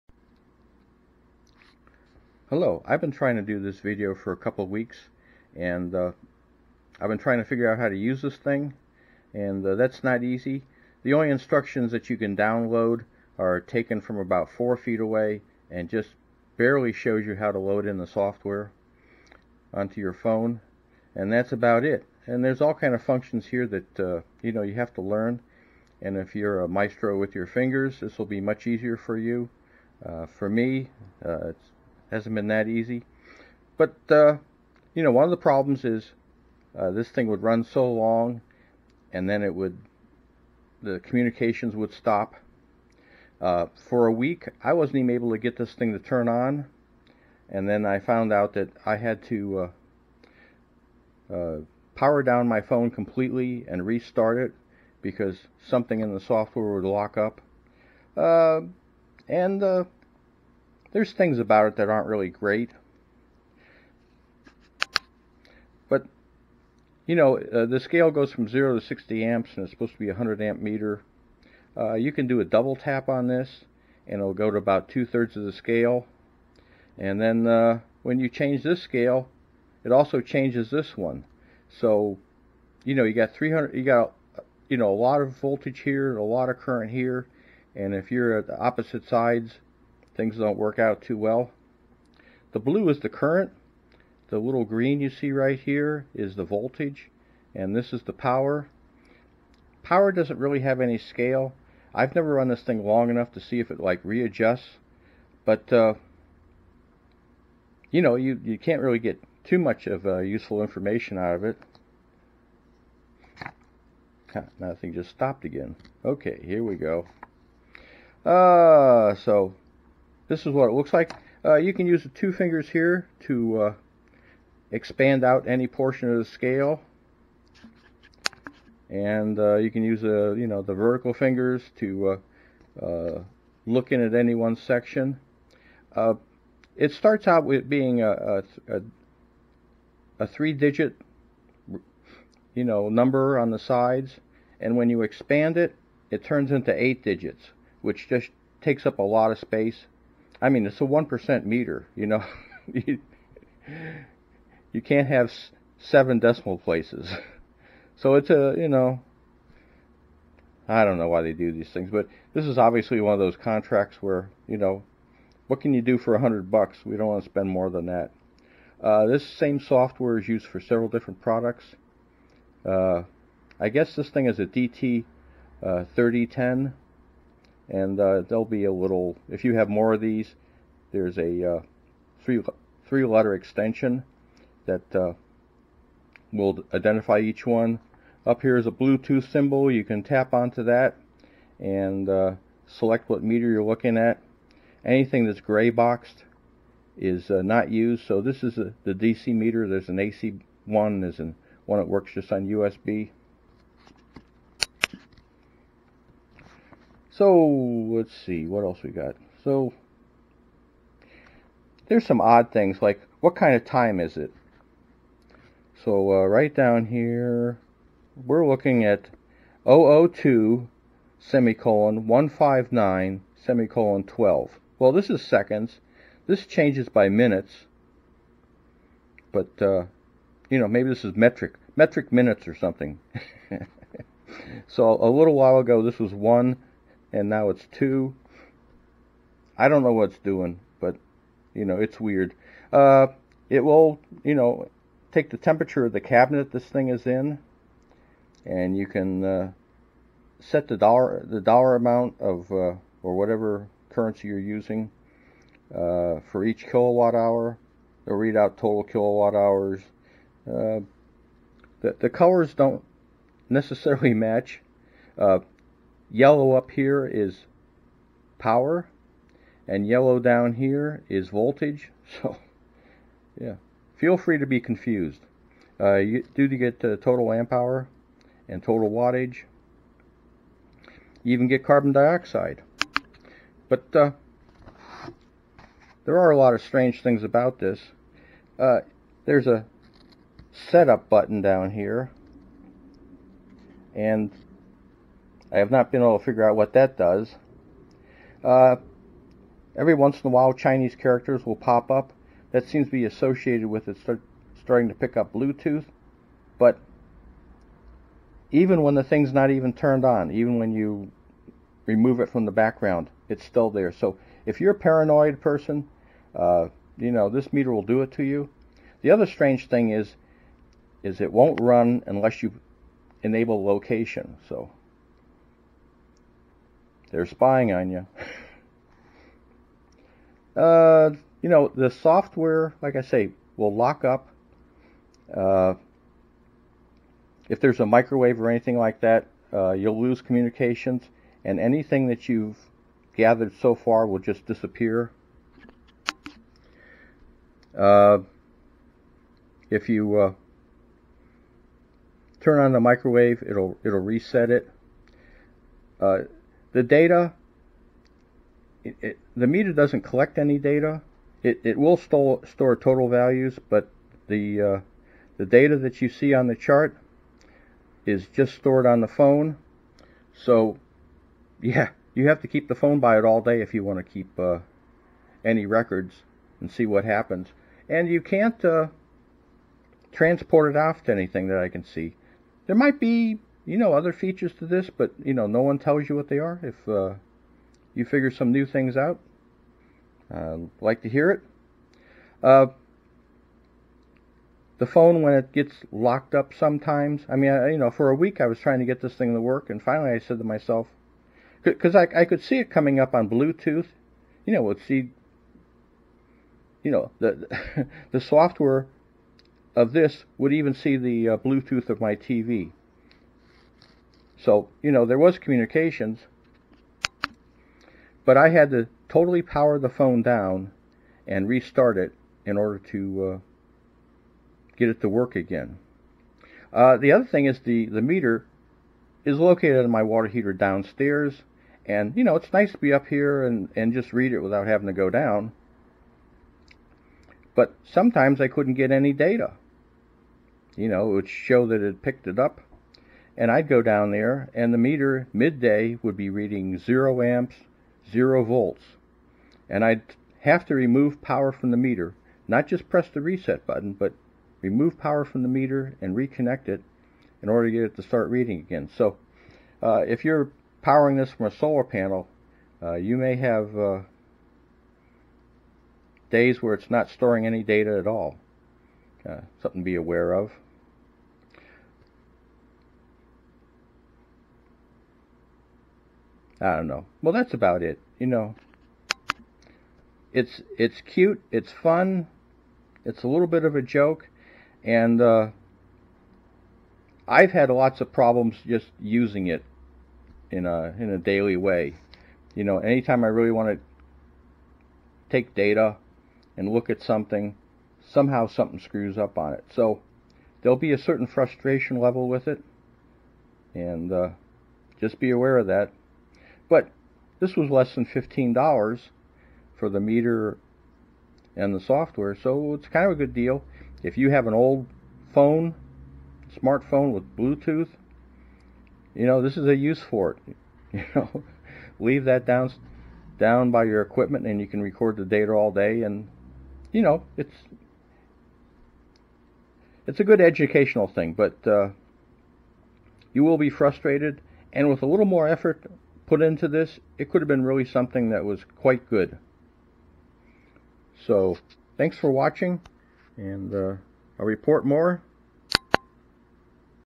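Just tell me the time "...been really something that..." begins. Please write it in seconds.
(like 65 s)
537 s.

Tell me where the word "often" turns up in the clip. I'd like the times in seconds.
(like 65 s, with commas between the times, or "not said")
not said.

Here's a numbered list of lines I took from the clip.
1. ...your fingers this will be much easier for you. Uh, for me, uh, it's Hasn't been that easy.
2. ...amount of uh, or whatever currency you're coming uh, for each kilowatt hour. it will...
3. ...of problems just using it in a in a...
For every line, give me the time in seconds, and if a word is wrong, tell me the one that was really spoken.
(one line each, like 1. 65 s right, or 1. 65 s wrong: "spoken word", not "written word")
1. 27 s right
2. 251 s wrong: "using", not "coming"
3. 487 s right.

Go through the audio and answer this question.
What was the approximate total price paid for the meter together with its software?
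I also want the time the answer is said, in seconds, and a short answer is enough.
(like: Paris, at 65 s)
Less than $15, at 507 s.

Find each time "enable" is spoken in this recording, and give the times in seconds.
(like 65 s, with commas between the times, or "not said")
323 s.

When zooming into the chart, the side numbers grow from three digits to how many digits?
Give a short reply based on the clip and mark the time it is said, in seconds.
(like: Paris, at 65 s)
8, at 146 s.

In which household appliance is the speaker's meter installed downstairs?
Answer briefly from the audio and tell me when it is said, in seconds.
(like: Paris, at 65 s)
Water heater, at 430 s.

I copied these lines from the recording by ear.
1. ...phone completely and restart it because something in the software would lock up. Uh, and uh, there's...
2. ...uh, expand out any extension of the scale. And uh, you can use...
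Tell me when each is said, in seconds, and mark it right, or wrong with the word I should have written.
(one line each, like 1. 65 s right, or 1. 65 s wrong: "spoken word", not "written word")
1. 52 s right
2. 123 s wrong: "portion", not "extension".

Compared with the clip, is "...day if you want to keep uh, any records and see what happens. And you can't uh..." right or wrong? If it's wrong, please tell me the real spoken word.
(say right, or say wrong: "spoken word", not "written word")
right.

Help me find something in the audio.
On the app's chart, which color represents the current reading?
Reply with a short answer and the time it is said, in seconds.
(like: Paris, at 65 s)
Blue, at 92 s.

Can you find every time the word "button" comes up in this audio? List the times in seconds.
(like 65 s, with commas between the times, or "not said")
291 s, 453 s.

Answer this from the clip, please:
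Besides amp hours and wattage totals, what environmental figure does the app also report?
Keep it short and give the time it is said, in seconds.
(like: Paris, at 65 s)
Carbon dioxide, at 281 s.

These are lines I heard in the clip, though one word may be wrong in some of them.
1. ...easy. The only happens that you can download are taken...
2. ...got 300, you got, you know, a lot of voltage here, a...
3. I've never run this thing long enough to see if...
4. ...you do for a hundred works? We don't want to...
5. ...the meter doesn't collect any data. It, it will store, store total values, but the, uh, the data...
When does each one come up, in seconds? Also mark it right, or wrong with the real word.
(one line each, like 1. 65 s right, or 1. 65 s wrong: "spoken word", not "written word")
1. 10 s wrong: "instructions", not "happens"
2. 83 s right
3. 101 s right
4. 165 s wrong: "bucks", not "works"
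5. 359 s right.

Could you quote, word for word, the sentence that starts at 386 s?
If uh, you figure some new things out, uh, like to hear it.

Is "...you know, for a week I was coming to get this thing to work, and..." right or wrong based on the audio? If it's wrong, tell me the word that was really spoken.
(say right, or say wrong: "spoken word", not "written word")
wrong: "trying", not "coming".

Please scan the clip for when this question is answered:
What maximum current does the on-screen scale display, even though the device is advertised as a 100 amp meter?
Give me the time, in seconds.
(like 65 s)
68 s.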